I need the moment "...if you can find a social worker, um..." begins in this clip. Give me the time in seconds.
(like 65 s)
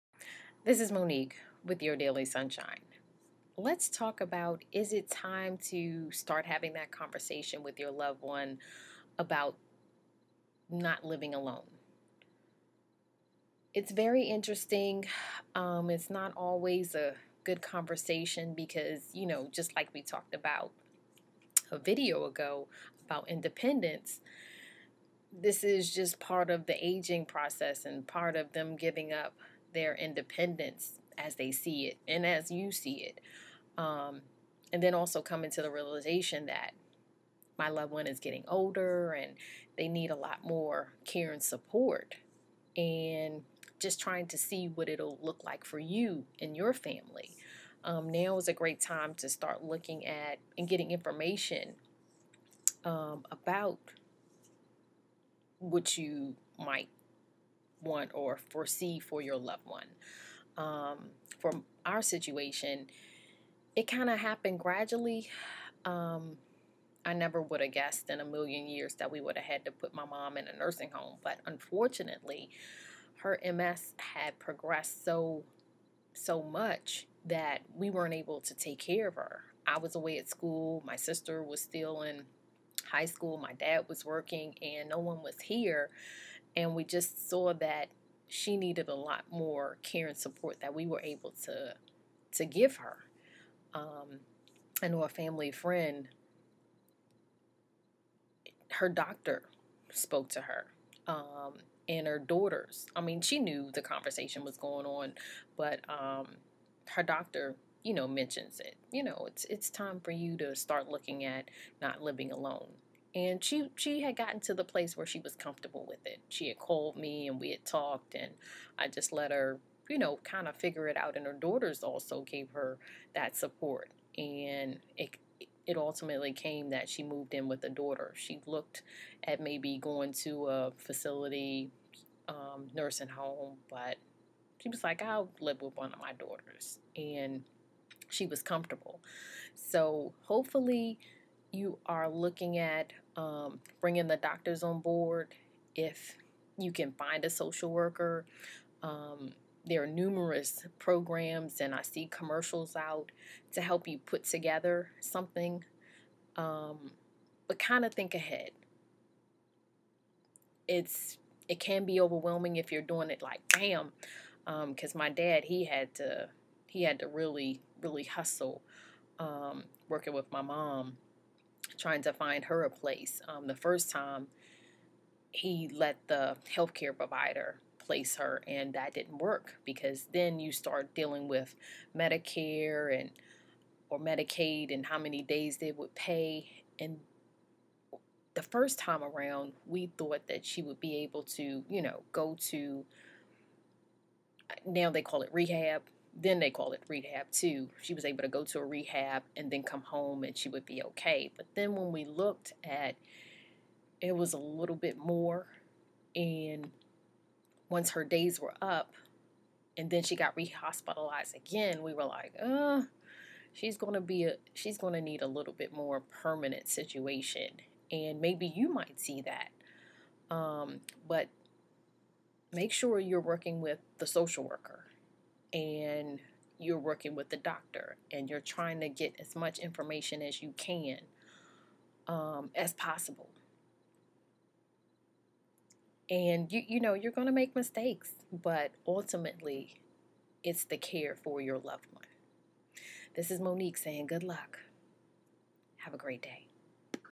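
145 s.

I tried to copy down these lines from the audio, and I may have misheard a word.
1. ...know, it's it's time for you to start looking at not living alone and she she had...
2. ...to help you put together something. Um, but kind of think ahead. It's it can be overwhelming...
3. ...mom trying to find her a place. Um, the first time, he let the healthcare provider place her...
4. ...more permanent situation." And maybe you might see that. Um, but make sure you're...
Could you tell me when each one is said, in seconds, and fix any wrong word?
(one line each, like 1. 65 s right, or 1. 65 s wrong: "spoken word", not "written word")
1. 109 s right
2. 153 s right
3. 170 s right
4. 215 s right.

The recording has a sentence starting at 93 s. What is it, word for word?
Um, I know a family friend, her doctor spoke to her.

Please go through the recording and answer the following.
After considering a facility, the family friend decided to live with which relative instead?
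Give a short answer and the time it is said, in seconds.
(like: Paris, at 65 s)
A daughter, at 127 s.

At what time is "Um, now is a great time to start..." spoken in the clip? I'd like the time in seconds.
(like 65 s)
47 s.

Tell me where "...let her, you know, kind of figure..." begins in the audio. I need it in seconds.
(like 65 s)
119 s.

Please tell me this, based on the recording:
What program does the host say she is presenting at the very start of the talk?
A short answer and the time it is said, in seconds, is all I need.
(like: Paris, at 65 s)
Daily Sunshine, at 1 s.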